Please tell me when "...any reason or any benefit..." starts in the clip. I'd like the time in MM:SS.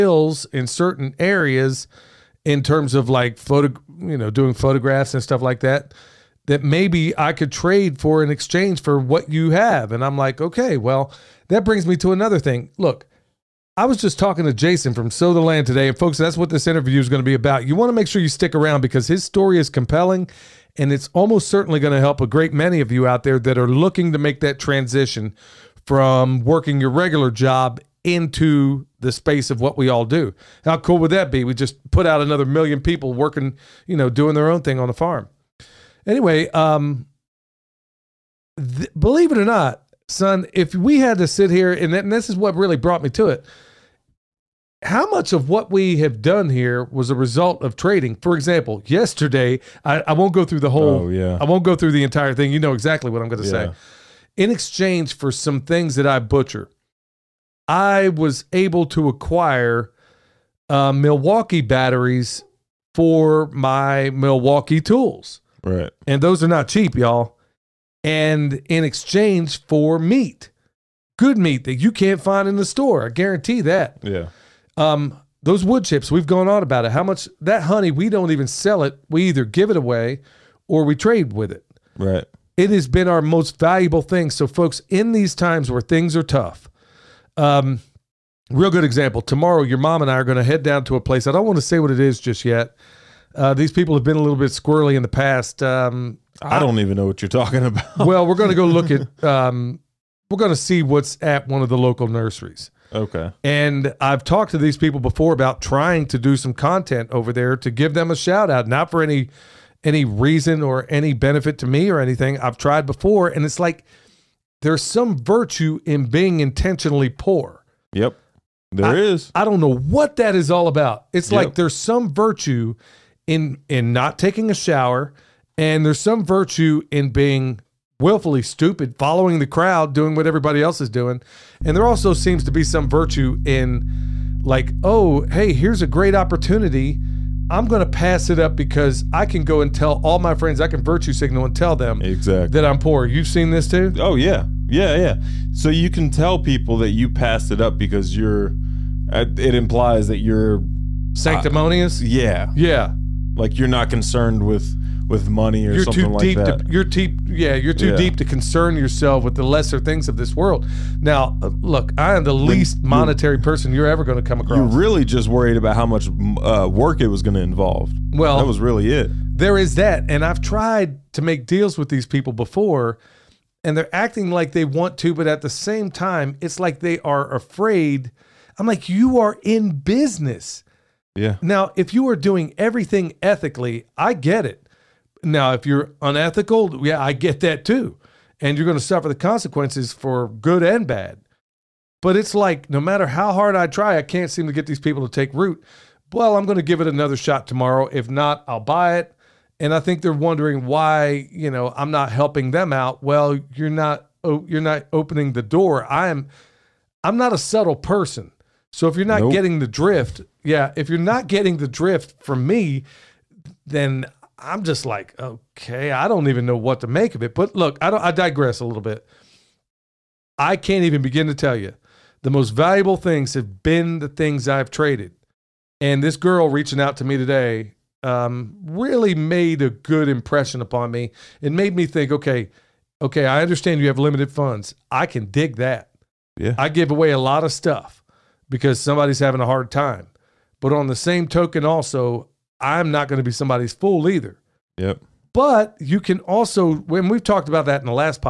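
01:49.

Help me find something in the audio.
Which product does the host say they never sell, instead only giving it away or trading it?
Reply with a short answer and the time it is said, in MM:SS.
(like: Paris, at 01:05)
Honey, at 01:17.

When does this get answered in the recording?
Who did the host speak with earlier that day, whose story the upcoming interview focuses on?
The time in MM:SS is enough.
00:14.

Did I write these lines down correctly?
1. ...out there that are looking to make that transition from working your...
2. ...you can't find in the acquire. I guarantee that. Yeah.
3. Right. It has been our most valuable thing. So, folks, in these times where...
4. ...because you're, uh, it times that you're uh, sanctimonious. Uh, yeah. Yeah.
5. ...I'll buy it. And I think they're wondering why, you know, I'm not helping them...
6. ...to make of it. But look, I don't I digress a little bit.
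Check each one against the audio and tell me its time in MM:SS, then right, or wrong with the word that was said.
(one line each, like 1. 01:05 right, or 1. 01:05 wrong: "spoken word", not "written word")
1. 00:23 right
2. 01:11 wrong: "store", not "acquire"
3. 01:21 right
4. 02:27 wrong: "implies", not "times"
5. 03:18 right
6. 03:36 right.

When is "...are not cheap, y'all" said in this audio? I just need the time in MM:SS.
01:06.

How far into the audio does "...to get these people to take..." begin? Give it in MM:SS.
03:14.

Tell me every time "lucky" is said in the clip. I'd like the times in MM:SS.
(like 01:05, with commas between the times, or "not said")
not said.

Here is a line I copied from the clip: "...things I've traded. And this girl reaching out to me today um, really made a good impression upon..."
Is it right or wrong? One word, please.
right.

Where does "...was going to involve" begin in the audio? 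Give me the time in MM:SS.
02:47.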